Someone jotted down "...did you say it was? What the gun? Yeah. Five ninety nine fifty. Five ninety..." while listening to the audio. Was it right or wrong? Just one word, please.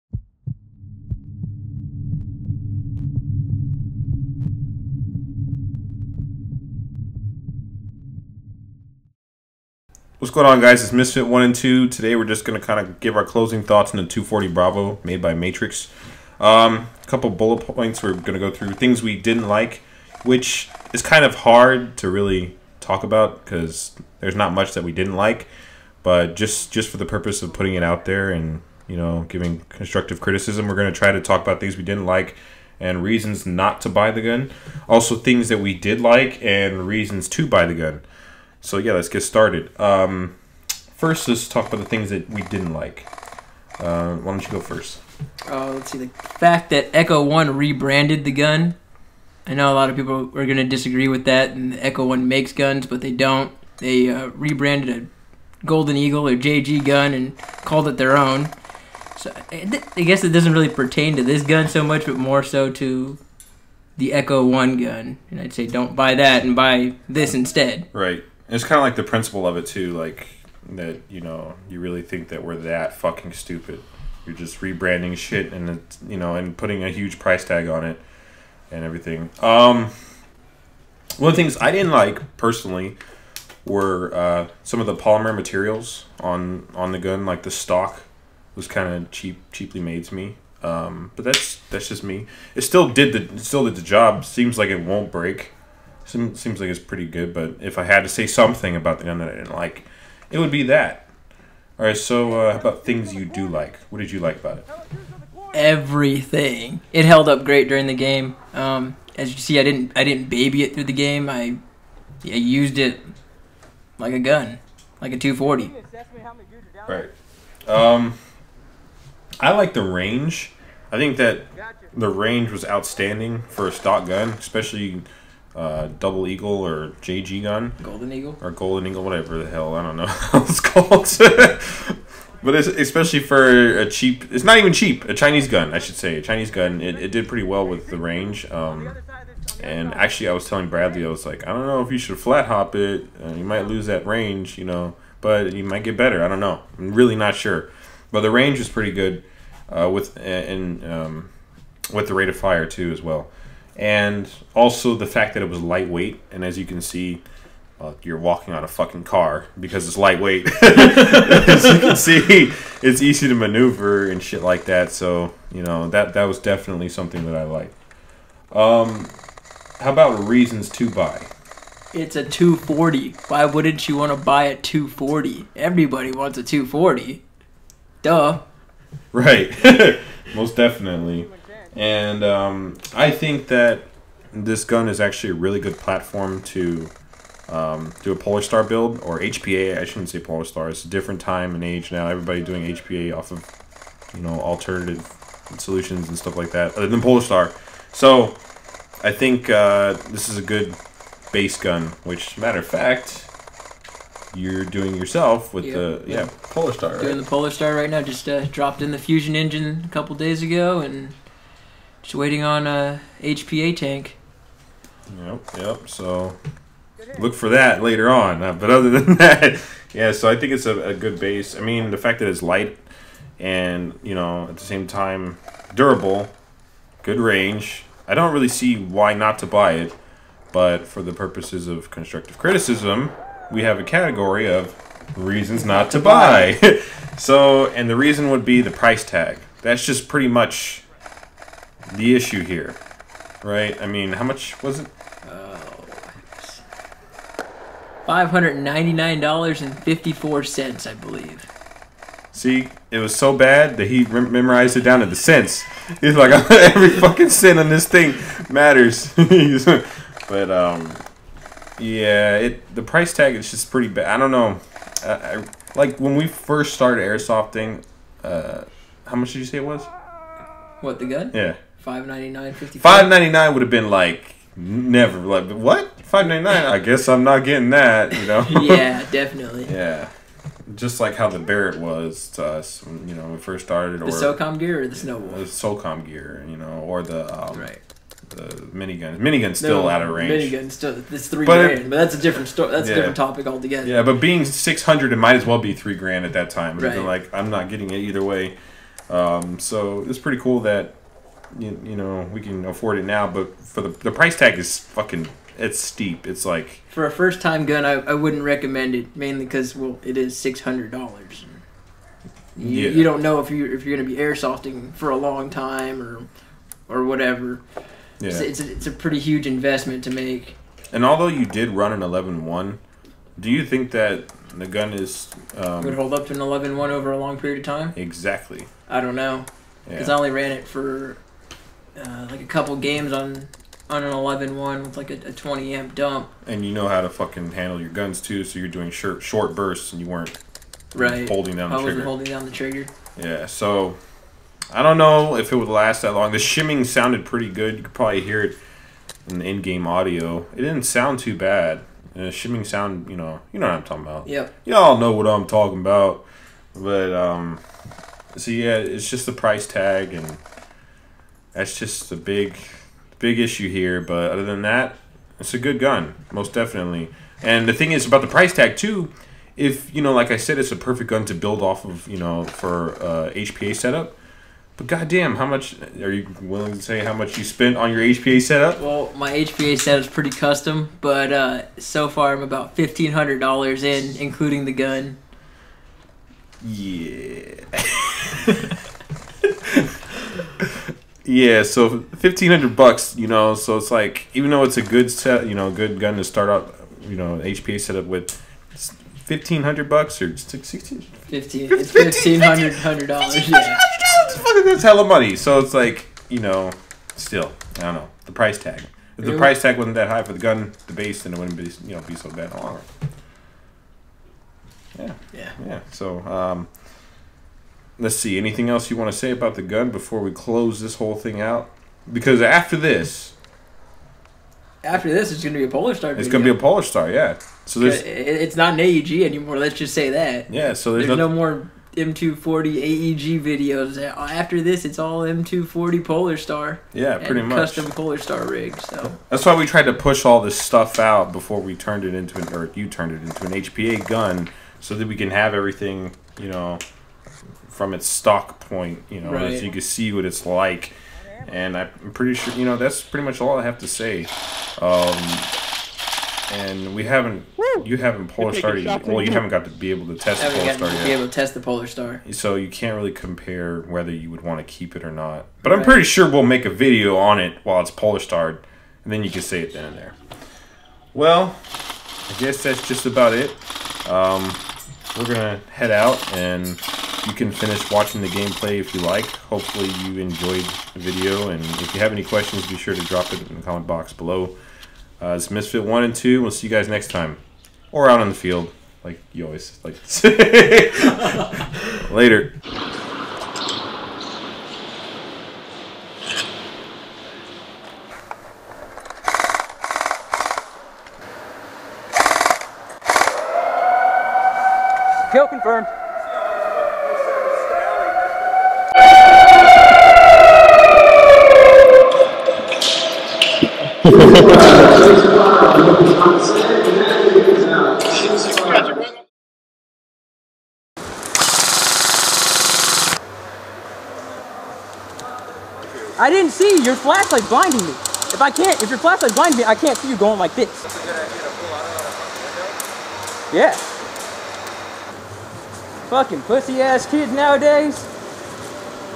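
right.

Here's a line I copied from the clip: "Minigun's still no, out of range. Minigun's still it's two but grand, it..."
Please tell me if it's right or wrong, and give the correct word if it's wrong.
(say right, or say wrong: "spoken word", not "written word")
wrong: "three", not "two".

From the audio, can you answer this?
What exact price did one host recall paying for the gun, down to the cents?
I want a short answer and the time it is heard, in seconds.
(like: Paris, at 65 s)
$599.54, at 248 s.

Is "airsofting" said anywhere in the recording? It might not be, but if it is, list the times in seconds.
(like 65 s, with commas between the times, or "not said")
267 s, 314 s.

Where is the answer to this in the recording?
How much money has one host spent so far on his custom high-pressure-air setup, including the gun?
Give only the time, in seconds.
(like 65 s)
382 s.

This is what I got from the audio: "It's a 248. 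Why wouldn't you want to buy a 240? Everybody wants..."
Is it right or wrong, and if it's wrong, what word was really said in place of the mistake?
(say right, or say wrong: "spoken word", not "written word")
wrong: "240", not "248".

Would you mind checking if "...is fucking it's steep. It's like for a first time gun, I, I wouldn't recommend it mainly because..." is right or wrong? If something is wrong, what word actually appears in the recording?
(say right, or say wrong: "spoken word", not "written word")
right.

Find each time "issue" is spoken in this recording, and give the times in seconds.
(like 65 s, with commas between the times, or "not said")
242 s, 363 s.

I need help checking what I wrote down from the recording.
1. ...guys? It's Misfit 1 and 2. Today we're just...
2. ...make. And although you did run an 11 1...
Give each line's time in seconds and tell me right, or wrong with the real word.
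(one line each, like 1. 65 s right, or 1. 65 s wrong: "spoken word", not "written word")
1. 10 s right
2. 320 s right.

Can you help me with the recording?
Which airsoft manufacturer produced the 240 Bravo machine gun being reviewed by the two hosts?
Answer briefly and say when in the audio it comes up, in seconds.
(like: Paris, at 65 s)
Matrix, at 15 s.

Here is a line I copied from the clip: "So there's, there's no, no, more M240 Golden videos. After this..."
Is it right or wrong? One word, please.
wrong.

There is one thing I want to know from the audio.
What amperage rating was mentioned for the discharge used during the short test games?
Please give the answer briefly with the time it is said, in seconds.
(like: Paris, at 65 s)
20 amp, at 335 s.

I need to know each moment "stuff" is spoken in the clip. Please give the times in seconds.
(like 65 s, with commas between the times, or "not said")
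196 s, 440 s.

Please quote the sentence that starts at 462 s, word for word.
So you can't really compare whether you would want to keep it or not.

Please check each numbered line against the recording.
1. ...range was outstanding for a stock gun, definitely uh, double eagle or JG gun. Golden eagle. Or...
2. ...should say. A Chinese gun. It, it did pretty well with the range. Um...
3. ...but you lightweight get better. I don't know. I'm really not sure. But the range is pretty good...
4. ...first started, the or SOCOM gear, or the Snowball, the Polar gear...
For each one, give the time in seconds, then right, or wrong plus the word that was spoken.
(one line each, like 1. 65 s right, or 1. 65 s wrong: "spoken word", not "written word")
1. 122 s wrong: "especially", not "definitely"
2. 135 s right
3. 145 s wrong: "might", not "lightweight"
4. 283 s wrong: "SOCOM", not "Polar".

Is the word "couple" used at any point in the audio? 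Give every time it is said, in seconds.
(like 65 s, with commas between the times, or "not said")
17 s, 209 s, 332 s.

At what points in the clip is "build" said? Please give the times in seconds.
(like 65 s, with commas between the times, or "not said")
188 s, 371 s.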